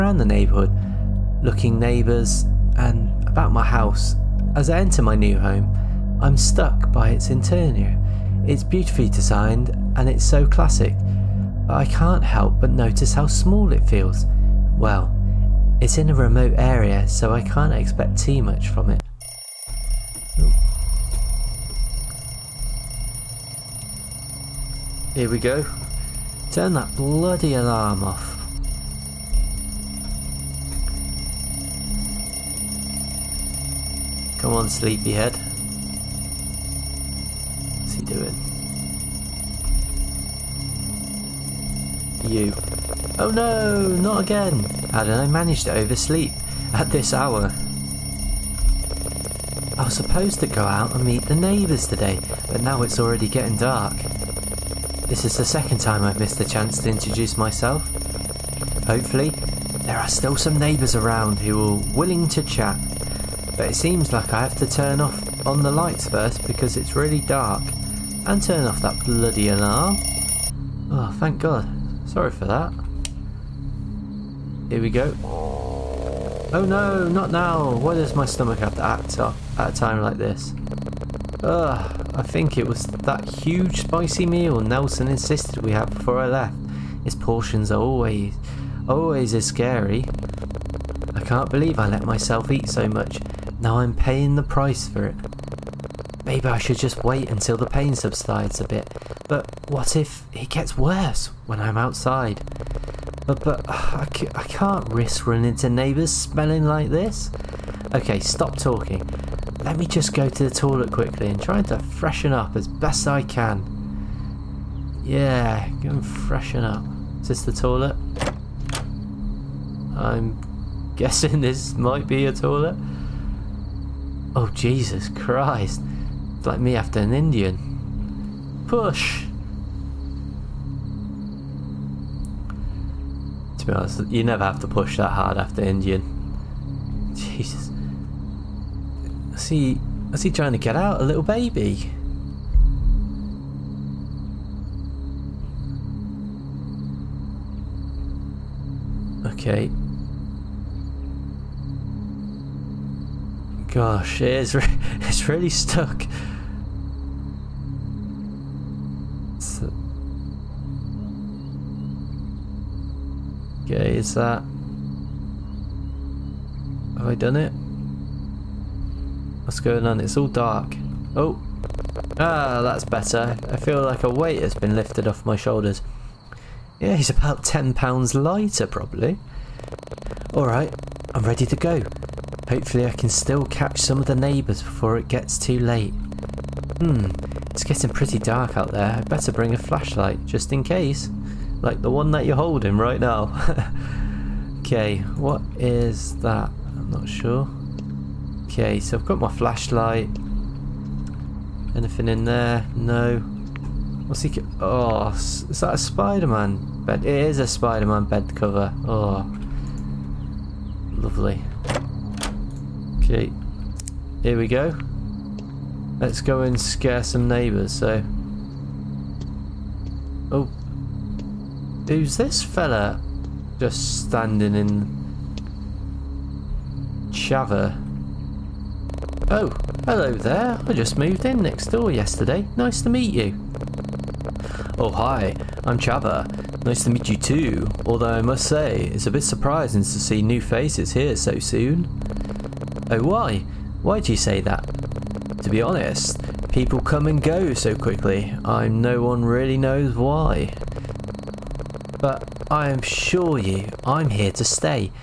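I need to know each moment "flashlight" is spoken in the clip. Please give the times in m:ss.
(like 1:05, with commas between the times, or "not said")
3:09, 3:19.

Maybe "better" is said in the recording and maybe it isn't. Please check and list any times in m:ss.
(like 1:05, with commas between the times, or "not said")
2:52, 3:09.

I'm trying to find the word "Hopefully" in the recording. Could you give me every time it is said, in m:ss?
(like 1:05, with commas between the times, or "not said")
0:58, 3:02.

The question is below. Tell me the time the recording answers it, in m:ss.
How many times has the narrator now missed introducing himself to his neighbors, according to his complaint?
0:55.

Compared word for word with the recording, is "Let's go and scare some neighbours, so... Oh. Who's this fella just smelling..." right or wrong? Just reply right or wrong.
wrong.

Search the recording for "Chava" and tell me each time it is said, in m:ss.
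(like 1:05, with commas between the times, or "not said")
3:47, 3:55.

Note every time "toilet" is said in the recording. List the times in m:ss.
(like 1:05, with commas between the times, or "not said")
1:50, 1:57, 2:02.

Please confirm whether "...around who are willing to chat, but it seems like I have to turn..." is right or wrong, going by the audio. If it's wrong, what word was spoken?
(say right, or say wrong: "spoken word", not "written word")
right.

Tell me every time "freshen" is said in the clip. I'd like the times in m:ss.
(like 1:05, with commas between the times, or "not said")
1:51, 1:56.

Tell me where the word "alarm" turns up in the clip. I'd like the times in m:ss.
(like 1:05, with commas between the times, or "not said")
0:27, 1:09.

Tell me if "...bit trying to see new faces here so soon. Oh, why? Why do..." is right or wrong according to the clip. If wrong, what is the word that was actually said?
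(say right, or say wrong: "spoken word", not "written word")
wrong: "surprising", not "trying".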